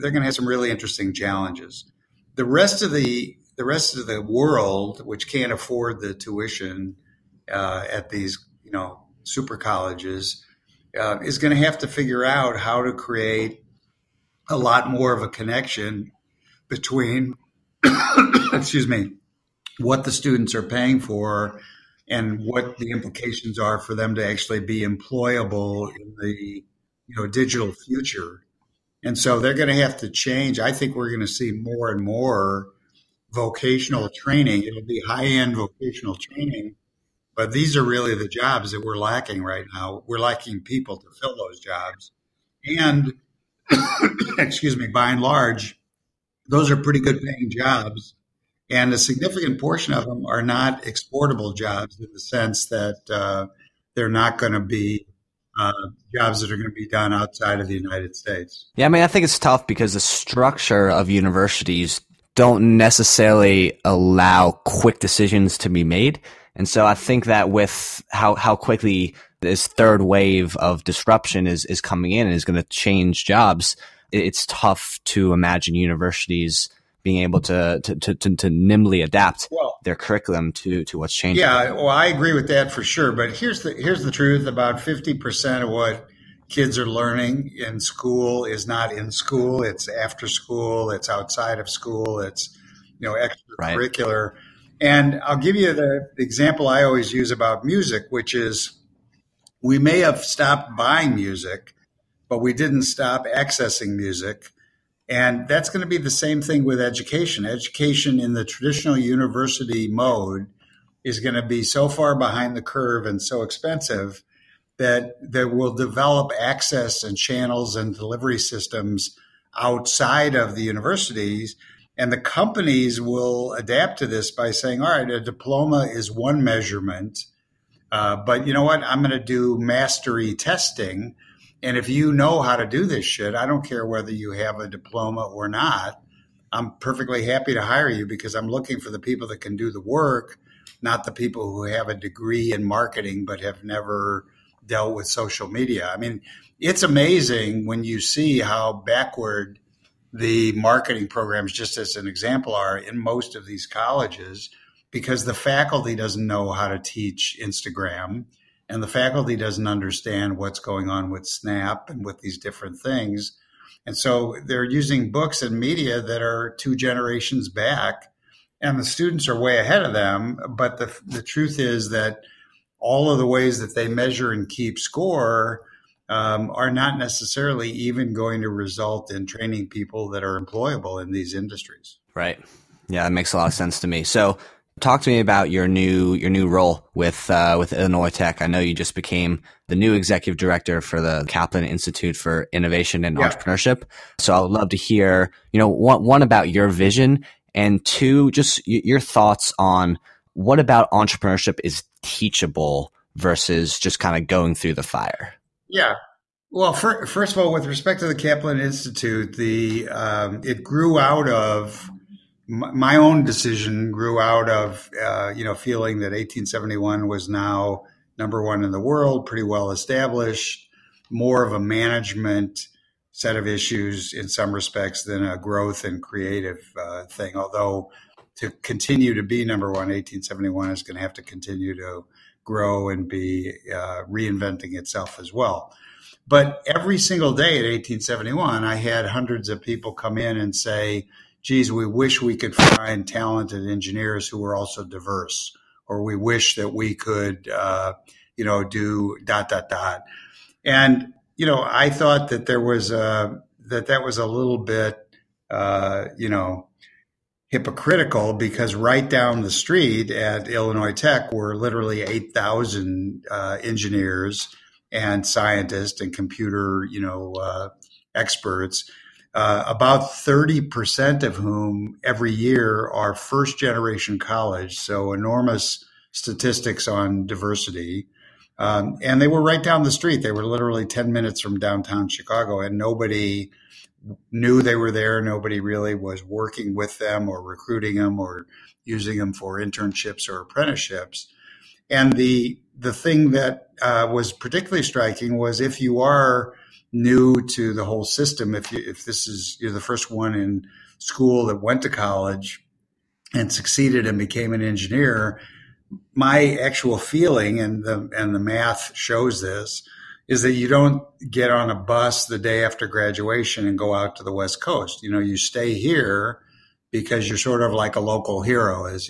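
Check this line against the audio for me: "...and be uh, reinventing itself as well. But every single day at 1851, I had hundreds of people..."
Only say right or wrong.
wrong.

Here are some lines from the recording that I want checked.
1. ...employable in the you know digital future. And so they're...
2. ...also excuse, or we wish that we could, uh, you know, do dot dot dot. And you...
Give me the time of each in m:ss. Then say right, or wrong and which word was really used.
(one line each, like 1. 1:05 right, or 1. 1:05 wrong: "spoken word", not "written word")
1. 0:24 right
2. 4:04 wrong: "diverse", not "excuse".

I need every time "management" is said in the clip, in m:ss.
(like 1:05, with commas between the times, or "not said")
3:41.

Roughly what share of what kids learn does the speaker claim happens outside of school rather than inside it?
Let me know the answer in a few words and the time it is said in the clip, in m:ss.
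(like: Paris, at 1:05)
50%, at 1:24.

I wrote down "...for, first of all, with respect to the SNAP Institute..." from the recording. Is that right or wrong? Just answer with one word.
wrong.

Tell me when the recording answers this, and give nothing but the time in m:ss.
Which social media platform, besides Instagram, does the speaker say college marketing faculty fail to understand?
2:41.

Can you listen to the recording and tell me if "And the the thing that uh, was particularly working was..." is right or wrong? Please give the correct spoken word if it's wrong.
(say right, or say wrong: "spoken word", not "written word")
wrong: "striking", not "working".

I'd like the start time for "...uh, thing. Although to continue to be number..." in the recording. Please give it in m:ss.
3:46.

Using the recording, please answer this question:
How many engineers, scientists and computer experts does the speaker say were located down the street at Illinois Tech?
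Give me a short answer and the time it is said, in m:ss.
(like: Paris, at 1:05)
8,000, at 4:22.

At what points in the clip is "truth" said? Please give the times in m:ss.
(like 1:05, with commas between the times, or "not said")
1:24, 2:51.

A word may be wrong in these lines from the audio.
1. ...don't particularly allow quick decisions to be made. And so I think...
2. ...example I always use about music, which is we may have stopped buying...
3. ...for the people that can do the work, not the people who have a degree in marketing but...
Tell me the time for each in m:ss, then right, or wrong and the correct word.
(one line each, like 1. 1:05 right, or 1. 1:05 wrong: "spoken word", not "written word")
1. 1:02 wrong: "necessarily", not "particularly"
2. 1:36 right
3. 2:18 right.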